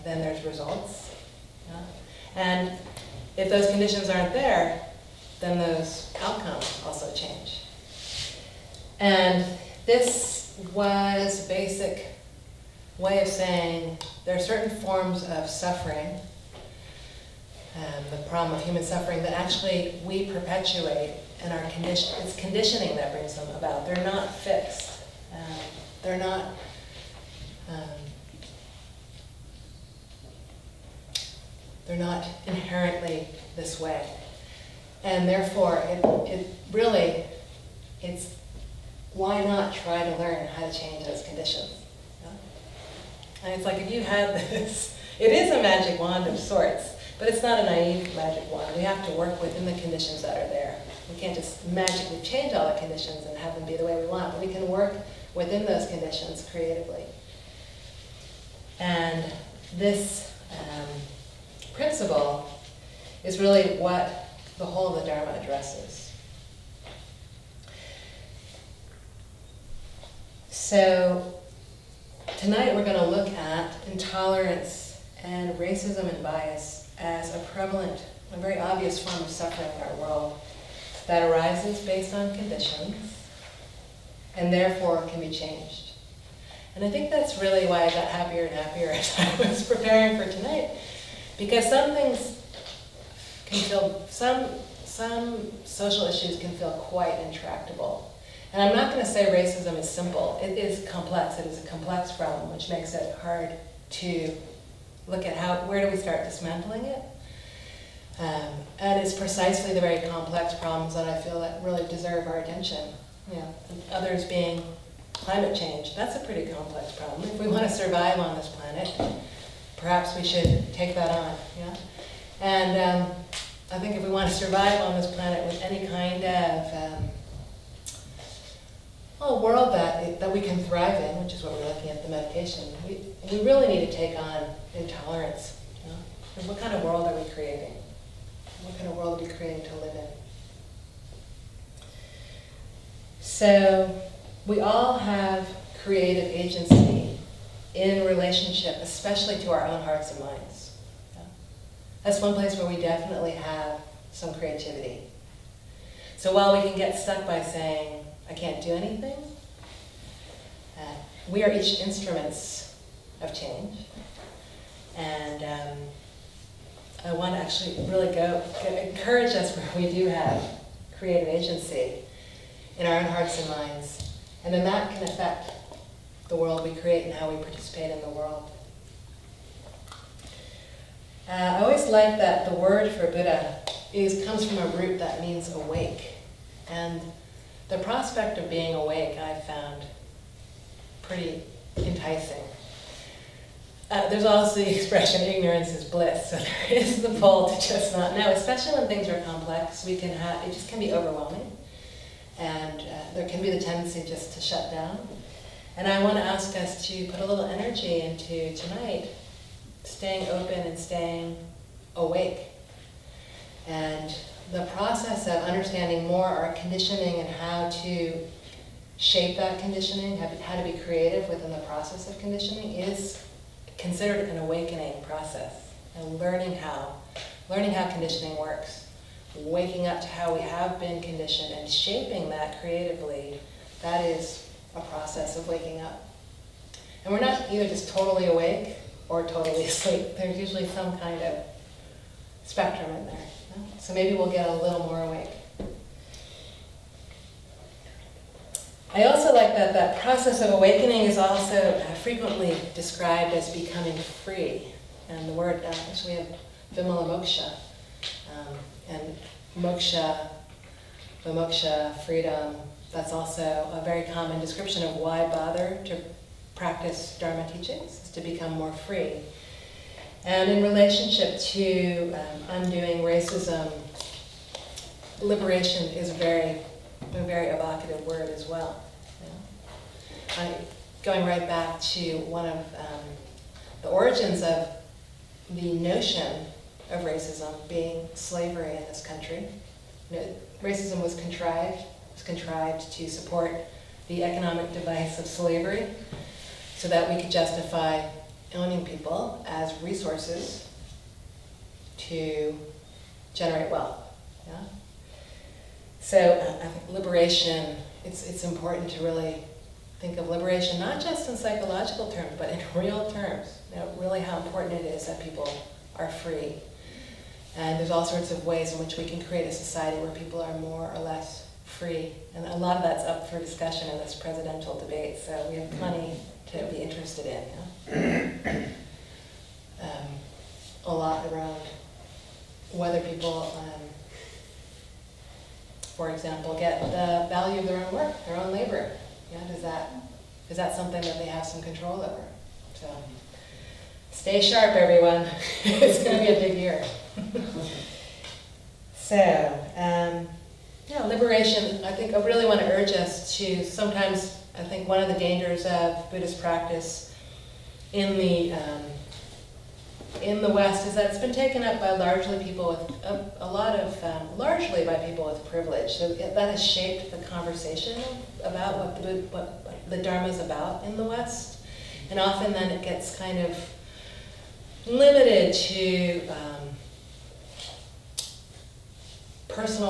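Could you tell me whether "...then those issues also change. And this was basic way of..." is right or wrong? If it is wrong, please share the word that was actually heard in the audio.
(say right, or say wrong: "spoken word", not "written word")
wrong: "outcomes", not "issues".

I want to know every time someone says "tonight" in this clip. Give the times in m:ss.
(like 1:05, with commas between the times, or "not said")
1:12, 1:30, 3:28.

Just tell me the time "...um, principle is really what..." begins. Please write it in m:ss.
1:00.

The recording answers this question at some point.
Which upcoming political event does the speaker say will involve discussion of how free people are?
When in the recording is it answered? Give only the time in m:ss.
5:24.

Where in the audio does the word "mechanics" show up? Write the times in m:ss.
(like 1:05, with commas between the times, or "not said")
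not said.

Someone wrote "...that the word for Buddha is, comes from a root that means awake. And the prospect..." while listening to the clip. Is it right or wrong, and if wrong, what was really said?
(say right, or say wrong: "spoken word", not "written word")
right.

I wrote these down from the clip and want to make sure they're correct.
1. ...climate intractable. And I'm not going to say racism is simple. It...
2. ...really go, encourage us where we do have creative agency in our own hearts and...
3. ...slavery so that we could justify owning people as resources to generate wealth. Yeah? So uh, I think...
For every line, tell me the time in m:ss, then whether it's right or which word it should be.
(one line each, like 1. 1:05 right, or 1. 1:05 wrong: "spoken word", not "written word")
1. 1:36 wrong: "quite", not "climate"
2. 2:47 right
3. 4:55 right.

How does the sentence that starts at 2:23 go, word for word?
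So we all have creative agency in relationship, especially to our own hearts and minds.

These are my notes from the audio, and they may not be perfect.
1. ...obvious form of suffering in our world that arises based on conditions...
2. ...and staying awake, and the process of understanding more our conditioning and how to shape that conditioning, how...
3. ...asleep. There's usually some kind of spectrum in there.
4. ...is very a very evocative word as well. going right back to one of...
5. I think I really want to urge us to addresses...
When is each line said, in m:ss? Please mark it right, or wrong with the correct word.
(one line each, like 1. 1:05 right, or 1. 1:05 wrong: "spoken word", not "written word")
1. 1:18 right
2. 3:30 right
3. 3:59 right
4. 4:35 right
5. 5:51 wrong: "sometimes", not "addresses".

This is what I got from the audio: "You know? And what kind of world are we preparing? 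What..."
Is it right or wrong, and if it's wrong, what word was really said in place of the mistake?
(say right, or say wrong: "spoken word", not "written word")
wrong: "creating", not "preparing".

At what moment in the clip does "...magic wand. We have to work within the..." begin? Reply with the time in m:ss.
0:48.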